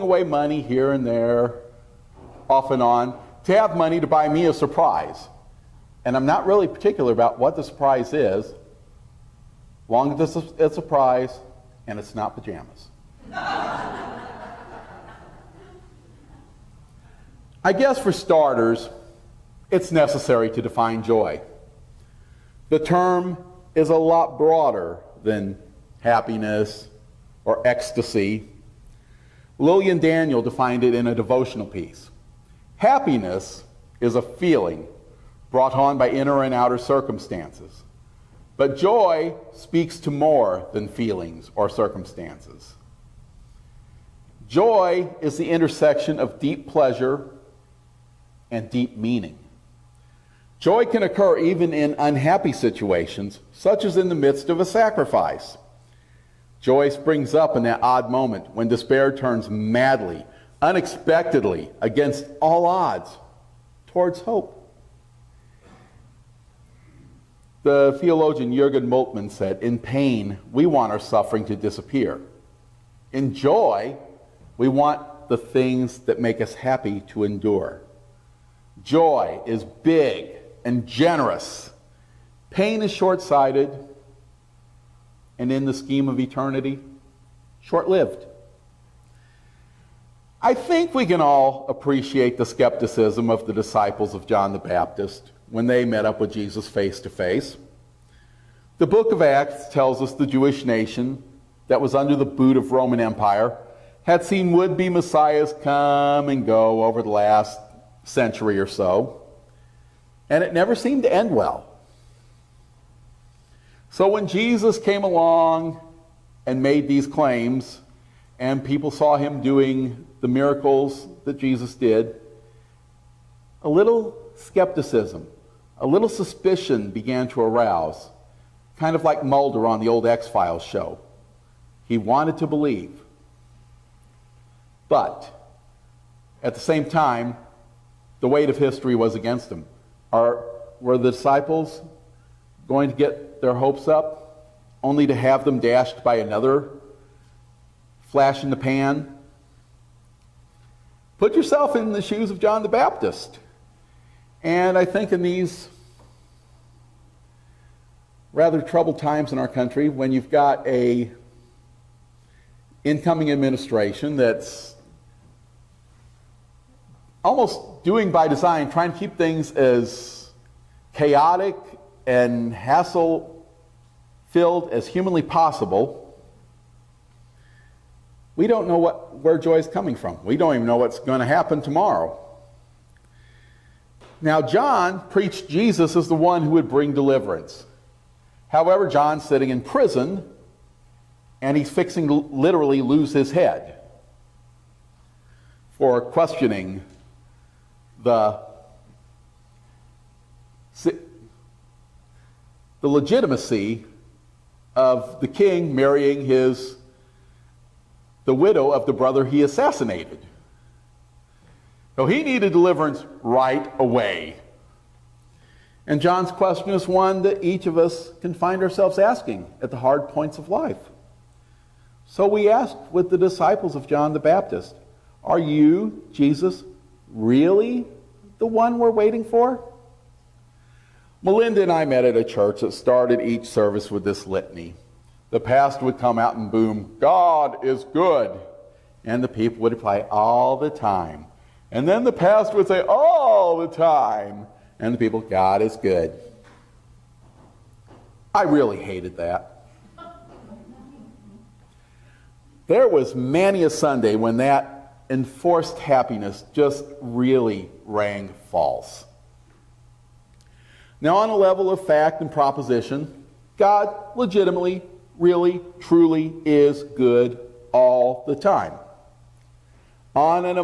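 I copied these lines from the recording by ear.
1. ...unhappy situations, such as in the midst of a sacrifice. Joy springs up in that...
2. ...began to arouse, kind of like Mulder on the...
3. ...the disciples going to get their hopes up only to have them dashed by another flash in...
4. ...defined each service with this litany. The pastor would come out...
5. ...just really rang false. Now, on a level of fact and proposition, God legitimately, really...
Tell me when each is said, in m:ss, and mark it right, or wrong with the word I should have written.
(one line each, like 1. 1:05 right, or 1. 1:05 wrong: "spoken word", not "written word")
1. 0:51 right
2. 2:06 right
3. 2:20 right
4. 3:52 wrong: "started", not "defined"
5. 4:16 right.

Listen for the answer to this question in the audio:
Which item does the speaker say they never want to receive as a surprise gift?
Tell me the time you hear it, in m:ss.
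0:12.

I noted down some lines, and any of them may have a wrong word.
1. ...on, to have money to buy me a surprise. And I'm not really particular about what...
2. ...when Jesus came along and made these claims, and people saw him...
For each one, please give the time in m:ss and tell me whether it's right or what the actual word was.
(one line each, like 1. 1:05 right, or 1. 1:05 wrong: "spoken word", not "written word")
1. 0:02 right
2. 1:54 right.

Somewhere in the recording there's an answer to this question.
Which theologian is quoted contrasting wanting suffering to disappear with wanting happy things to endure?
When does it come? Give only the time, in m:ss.
1:08.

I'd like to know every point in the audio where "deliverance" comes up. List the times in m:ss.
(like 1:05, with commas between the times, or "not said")
3:06, 3:32.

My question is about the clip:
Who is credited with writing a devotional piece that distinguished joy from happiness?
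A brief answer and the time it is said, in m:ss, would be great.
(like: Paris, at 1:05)
Lillian Daniel, at 0:29.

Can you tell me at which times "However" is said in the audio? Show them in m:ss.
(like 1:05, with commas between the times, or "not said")
3:08.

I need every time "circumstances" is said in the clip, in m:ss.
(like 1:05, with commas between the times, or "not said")
0:36, 0:41.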